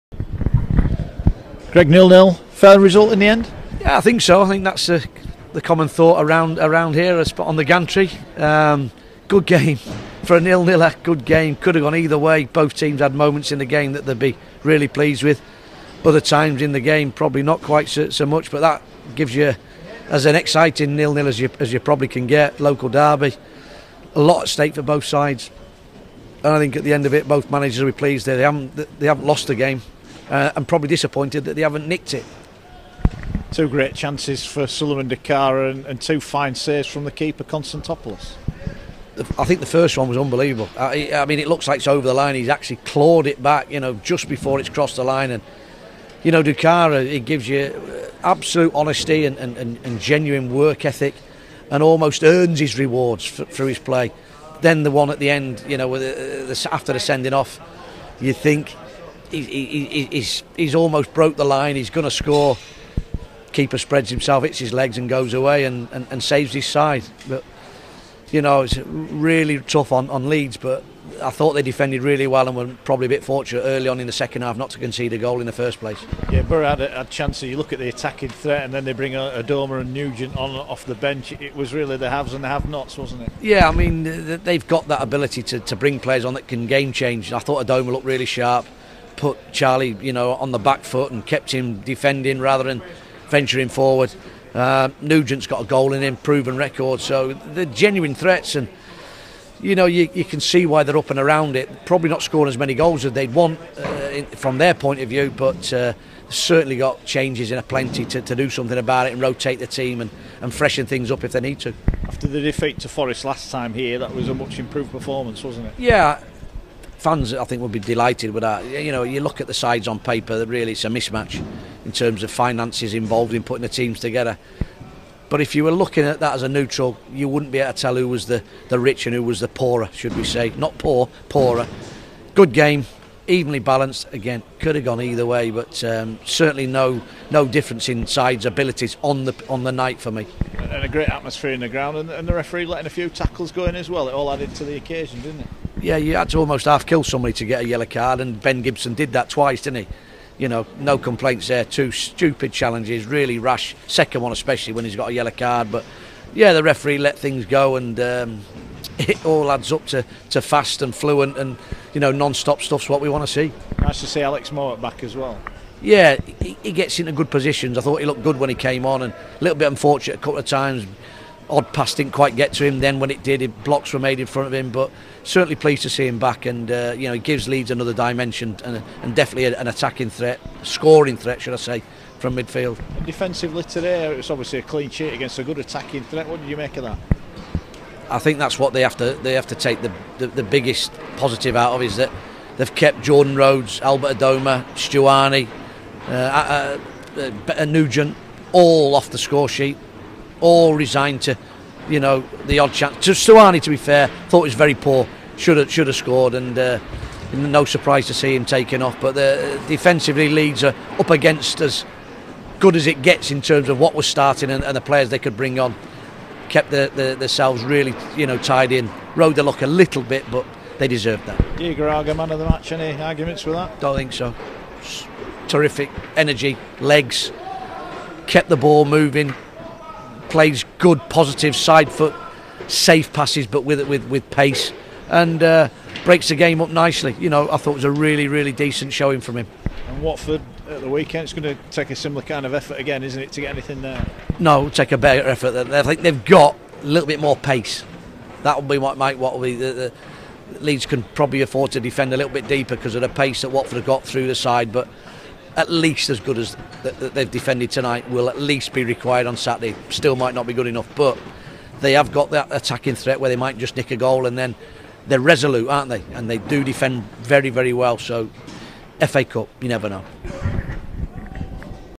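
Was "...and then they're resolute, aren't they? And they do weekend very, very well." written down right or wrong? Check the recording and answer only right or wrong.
wrong.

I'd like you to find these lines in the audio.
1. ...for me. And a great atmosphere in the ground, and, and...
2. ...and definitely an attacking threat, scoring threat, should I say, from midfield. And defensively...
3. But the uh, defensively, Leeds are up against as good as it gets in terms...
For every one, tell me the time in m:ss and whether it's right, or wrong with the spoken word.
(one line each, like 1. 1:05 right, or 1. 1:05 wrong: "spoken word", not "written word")
1. 2:20 right
2. 2:59 right
3. 3:28 right.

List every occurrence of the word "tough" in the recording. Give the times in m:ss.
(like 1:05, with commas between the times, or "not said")
1:09.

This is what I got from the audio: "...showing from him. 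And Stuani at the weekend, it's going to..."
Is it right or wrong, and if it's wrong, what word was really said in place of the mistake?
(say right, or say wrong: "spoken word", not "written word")
wrong: "Watford", not "Stuani".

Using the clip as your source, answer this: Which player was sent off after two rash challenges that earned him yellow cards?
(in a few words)
Ben Gibson.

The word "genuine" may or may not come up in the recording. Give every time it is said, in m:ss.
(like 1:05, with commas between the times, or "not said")
0:49, 1:37.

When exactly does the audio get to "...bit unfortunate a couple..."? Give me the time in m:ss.
2:49.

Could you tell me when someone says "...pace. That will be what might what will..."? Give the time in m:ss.
4:07.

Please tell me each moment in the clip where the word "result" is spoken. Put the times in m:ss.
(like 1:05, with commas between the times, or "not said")
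0:02.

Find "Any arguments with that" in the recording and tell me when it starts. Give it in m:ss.
3:42.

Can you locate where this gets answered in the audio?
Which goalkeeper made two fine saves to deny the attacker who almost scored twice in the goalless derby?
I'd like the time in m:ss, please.
0:37.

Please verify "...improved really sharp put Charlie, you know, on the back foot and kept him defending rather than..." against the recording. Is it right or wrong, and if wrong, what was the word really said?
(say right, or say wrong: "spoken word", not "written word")
wrong: "looked", not "improved".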